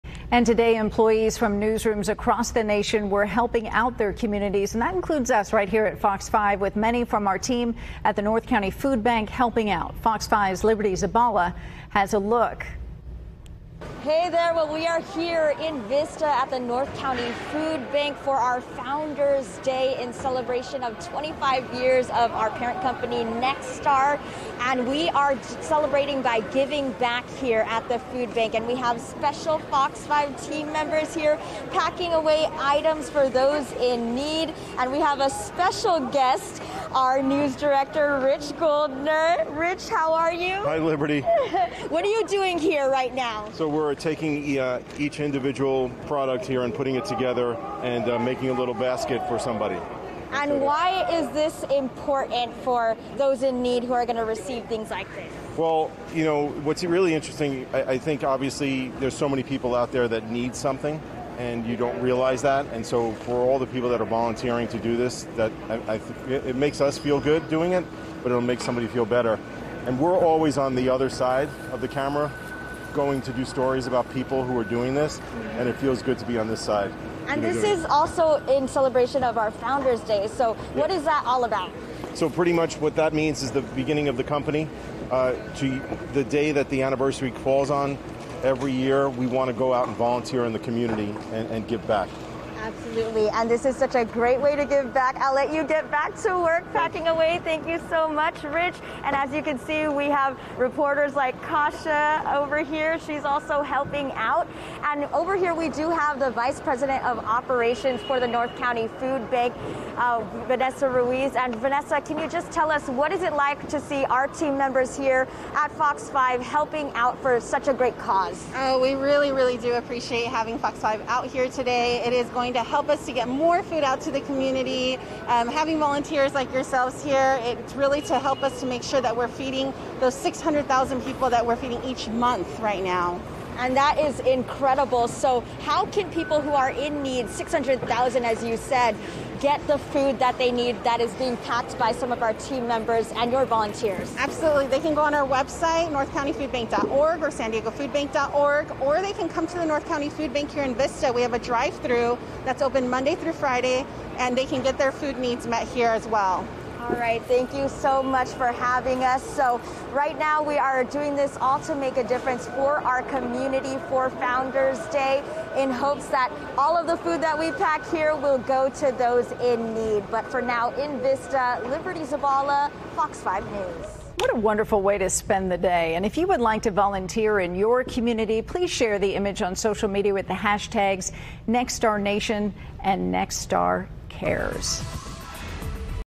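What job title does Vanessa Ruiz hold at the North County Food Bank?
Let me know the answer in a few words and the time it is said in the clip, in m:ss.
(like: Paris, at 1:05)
Vice President of Operations, at 1:46.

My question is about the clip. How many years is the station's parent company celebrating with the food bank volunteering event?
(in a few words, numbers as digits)
25.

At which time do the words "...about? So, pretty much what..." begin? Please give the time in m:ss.
1:21.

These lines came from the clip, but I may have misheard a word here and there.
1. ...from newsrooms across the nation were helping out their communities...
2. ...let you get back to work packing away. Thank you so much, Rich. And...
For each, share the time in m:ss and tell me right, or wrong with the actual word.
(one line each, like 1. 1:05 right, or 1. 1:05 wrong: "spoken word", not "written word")
1. 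0:01 right
2. 1:35 right.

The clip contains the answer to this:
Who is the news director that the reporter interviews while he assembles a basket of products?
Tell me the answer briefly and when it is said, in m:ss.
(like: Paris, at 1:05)
Rich Goldner, at 0:38.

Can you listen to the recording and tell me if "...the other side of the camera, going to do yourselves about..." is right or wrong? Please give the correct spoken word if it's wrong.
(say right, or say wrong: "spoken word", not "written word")
wrong: "stories", not "yourselves".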